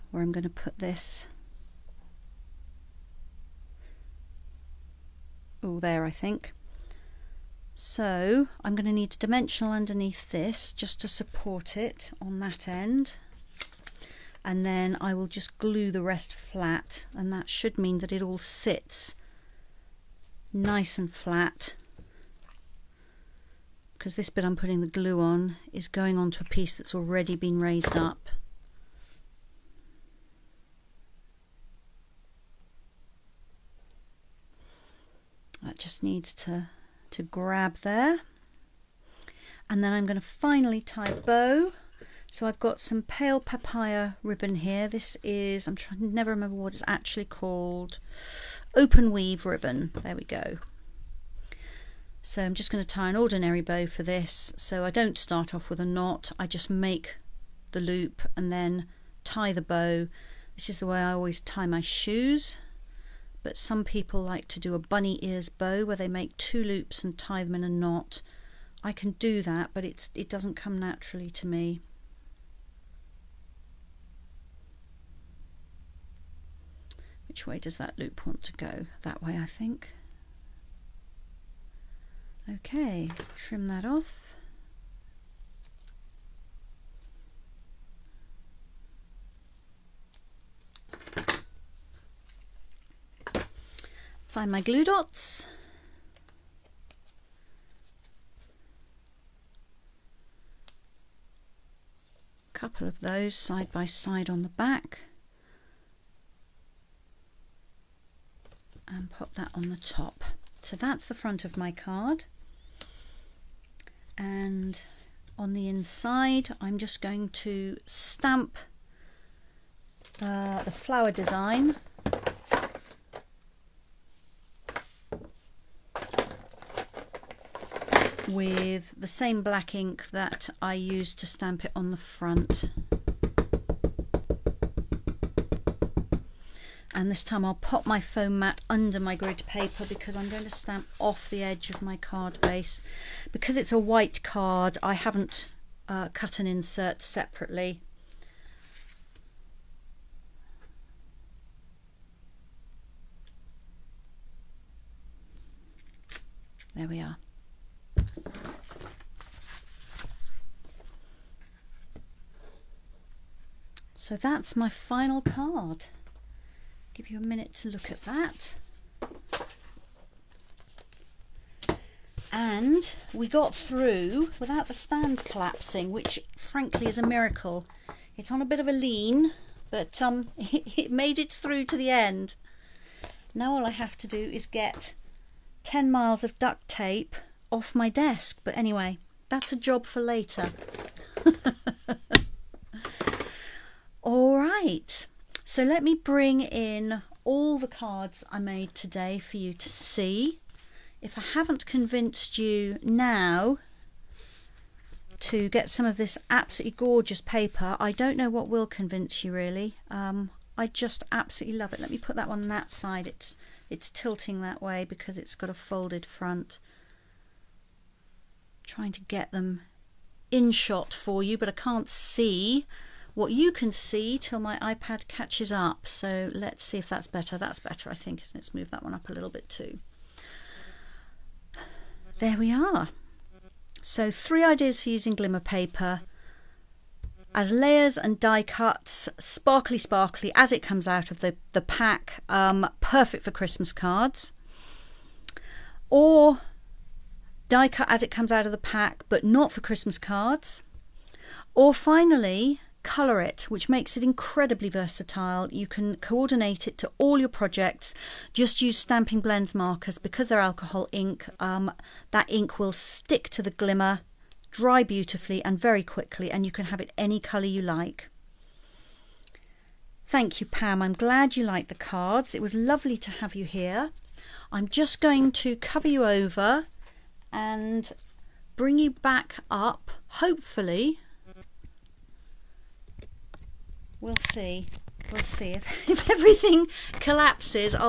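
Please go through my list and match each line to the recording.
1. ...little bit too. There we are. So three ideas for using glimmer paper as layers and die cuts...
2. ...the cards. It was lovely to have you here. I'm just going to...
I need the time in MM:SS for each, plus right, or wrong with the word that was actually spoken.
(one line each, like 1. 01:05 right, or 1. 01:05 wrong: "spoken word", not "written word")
1. 03:49 right
2. 04:31 right.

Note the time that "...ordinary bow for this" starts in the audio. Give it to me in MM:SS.
00:53.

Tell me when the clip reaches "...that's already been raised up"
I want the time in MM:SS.
00:26.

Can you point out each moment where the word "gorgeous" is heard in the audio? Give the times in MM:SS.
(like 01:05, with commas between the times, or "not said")
03:26.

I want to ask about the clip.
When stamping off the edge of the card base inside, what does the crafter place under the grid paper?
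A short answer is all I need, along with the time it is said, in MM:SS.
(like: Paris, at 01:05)
Foam mat, at 02:17.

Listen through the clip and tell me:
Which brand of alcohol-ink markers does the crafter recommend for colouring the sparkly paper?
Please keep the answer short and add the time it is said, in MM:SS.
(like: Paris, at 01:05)
Stampin' Blends, at 04:18.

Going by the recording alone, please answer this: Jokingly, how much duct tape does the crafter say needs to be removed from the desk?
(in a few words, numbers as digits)
10 miles.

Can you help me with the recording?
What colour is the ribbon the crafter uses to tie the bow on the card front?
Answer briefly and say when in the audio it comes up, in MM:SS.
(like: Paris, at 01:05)
Pale papaya, at 00:43.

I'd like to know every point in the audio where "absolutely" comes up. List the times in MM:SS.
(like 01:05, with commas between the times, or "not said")
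03:26, 03:31.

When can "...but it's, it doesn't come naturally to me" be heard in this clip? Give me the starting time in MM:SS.
01:09.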